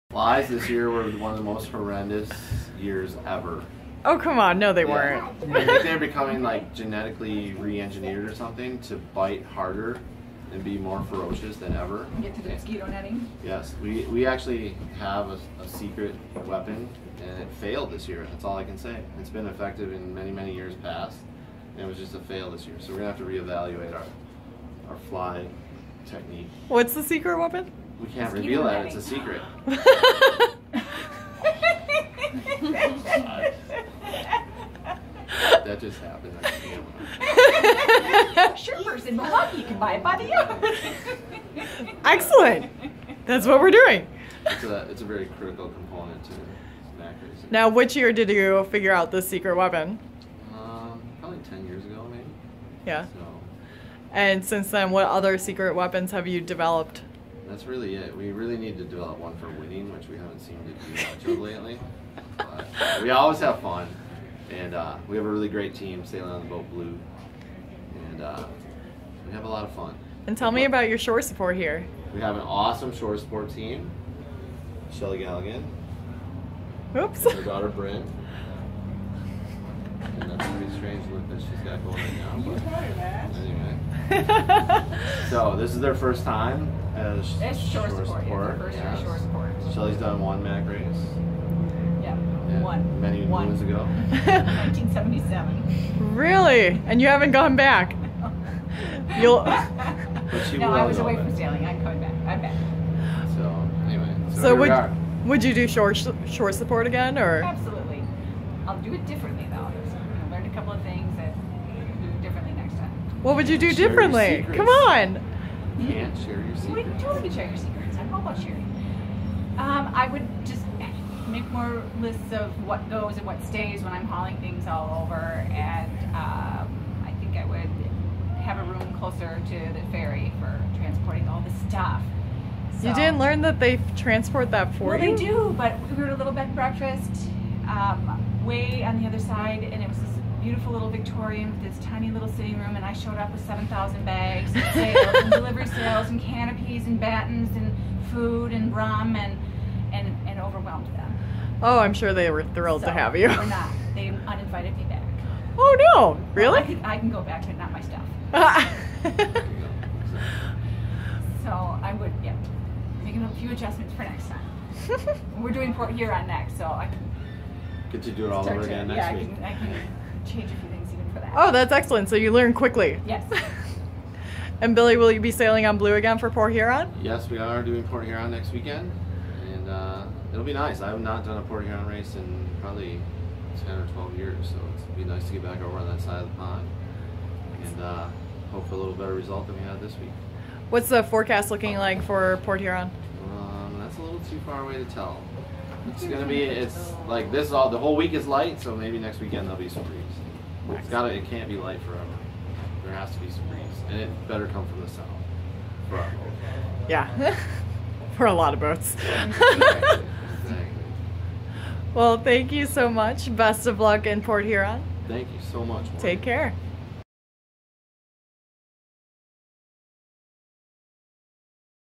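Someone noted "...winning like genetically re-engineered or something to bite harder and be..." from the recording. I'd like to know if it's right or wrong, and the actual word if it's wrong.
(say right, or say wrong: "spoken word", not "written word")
wrong: "becoming", not "winning".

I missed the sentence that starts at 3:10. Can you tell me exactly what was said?
What's the forecast looking like for Port Huron?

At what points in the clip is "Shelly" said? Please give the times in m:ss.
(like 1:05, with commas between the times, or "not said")
1:14, 1:29.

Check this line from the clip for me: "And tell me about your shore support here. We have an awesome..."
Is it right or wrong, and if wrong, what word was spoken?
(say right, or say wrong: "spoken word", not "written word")
right.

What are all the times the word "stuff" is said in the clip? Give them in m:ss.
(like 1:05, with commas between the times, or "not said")
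2:11, 2:37.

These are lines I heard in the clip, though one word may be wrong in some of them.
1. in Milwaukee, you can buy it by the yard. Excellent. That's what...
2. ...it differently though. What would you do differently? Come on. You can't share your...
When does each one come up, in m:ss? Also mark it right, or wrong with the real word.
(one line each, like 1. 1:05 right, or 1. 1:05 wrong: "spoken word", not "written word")
1. 0:39 right
2. 1:48 right.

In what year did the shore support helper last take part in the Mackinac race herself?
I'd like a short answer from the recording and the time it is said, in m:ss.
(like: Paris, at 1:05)
1977, at 1:34.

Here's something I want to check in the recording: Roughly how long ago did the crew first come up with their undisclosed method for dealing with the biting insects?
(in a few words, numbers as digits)
10 years ago.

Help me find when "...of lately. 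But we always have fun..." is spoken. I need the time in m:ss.
1:01.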